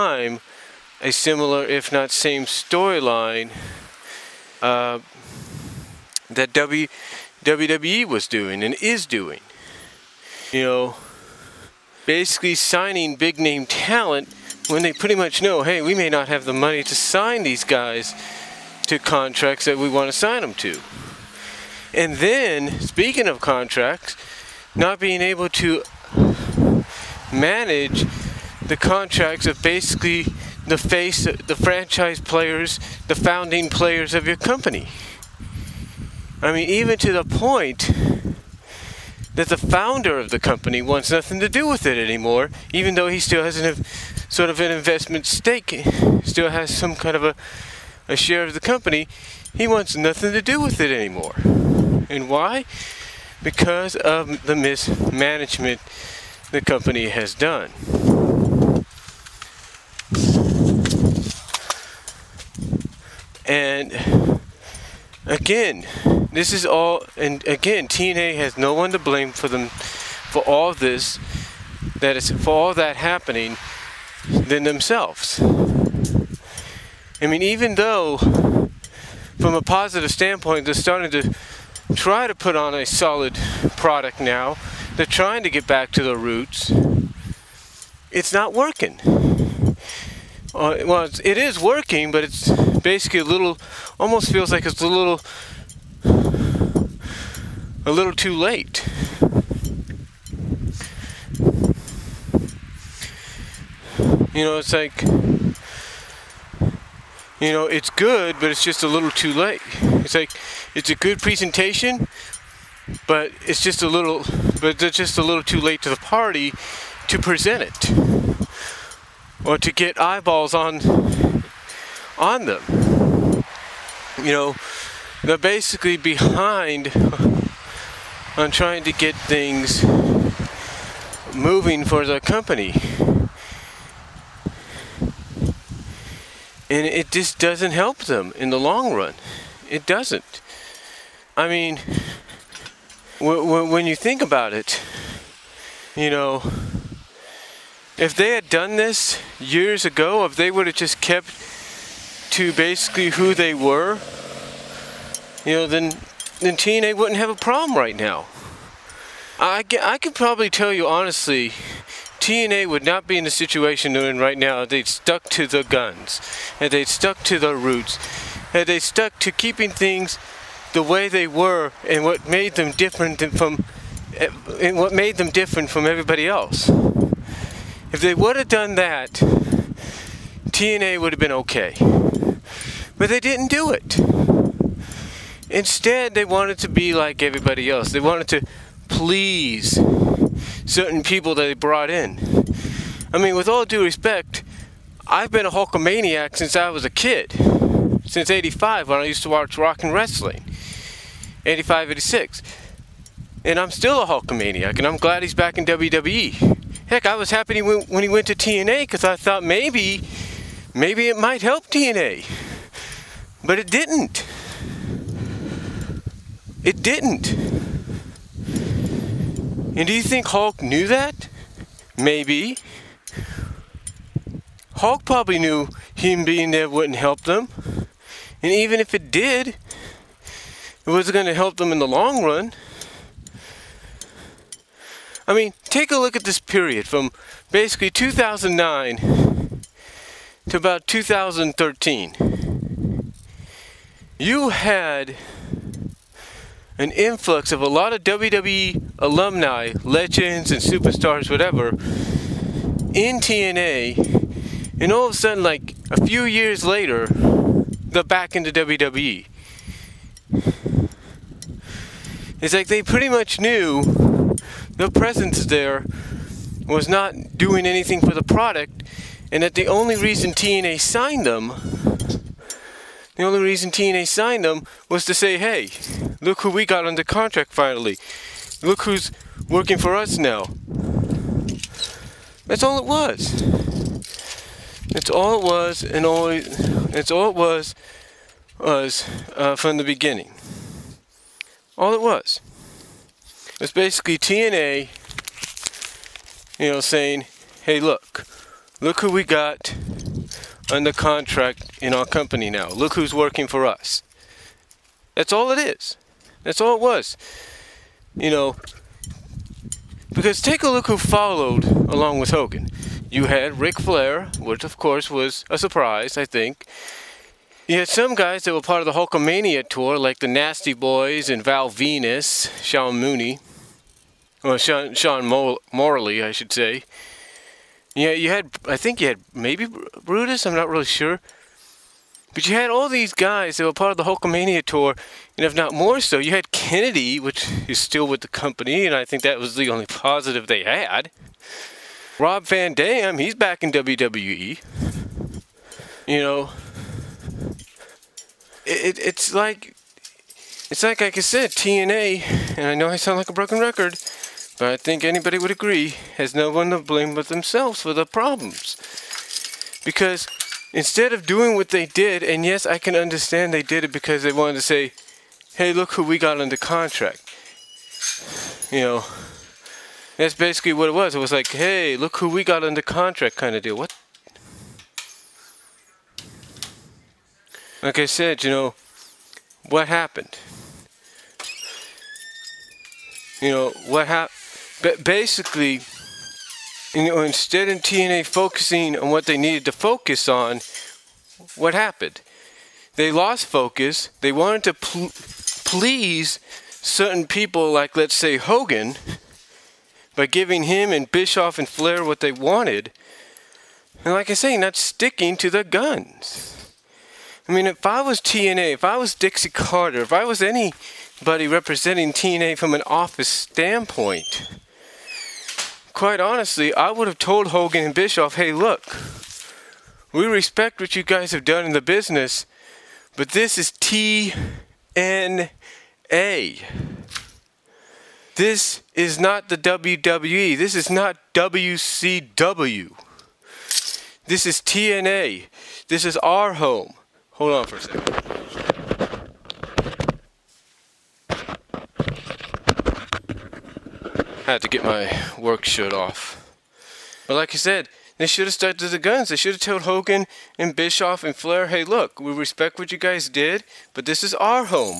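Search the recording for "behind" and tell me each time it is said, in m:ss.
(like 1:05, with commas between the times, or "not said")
2:05.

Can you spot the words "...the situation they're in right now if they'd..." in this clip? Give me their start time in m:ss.
2:43.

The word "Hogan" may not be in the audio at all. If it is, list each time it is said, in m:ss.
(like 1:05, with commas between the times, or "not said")
5:12, 6:38, 6:57, 7:29.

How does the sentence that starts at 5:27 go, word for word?
Yeah, you had, I think you had maybe Brutus, I'm not really sure.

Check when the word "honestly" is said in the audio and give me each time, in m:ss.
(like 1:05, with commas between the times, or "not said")
2:40, 6:56.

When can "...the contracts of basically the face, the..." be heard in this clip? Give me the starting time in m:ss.
0:28.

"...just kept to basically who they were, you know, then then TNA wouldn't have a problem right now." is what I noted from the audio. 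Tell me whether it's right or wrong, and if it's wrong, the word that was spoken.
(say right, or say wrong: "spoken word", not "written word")
right.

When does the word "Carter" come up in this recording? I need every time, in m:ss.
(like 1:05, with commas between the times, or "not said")
6:49.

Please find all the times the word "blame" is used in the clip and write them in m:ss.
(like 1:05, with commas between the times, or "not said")
1:08, 5:56.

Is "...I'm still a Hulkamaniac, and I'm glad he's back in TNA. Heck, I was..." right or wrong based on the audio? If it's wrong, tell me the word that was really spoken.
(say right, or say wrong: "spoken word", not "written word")
wrong: "WWE", not "TNA".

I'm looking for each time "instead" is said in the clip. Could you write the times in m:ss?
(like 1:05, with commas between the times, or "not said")
3:05, 6:00, 6:27.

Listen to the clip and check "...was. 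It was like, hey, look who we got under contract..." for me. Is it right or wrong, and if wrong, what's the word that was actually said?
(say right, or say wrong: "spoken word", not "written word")
right.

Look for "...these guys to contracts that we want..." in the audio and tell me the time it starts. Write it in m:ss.
0:17.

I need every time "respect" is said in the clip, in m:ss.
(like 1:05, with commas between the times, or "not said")
3:13, 7:00, 7:32.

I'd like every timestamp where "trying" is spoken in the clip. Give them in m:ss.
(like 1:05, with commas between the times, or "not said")
1:25, 2:08.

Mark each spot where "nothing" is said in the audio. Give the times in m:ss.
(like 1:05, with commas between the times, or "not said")
0:41, 0:49.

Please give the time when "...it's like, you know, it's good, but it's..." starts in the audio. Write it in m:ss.
1:44.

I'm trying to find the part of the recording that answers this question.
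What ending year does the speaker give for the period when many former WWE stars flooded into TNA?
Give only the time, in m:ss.
4:00.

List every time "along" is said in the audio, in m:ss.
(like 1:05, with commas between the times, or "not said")
5:11.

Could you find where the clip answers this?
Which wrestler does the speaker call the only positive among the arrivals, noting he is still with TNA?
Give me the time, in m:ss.
5:36.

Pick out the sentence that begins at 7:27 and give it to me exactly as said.
But like I said, they should have stuck to the guns.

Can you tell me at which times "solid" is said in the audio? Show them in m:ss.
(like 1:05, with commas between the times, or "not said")
1:22.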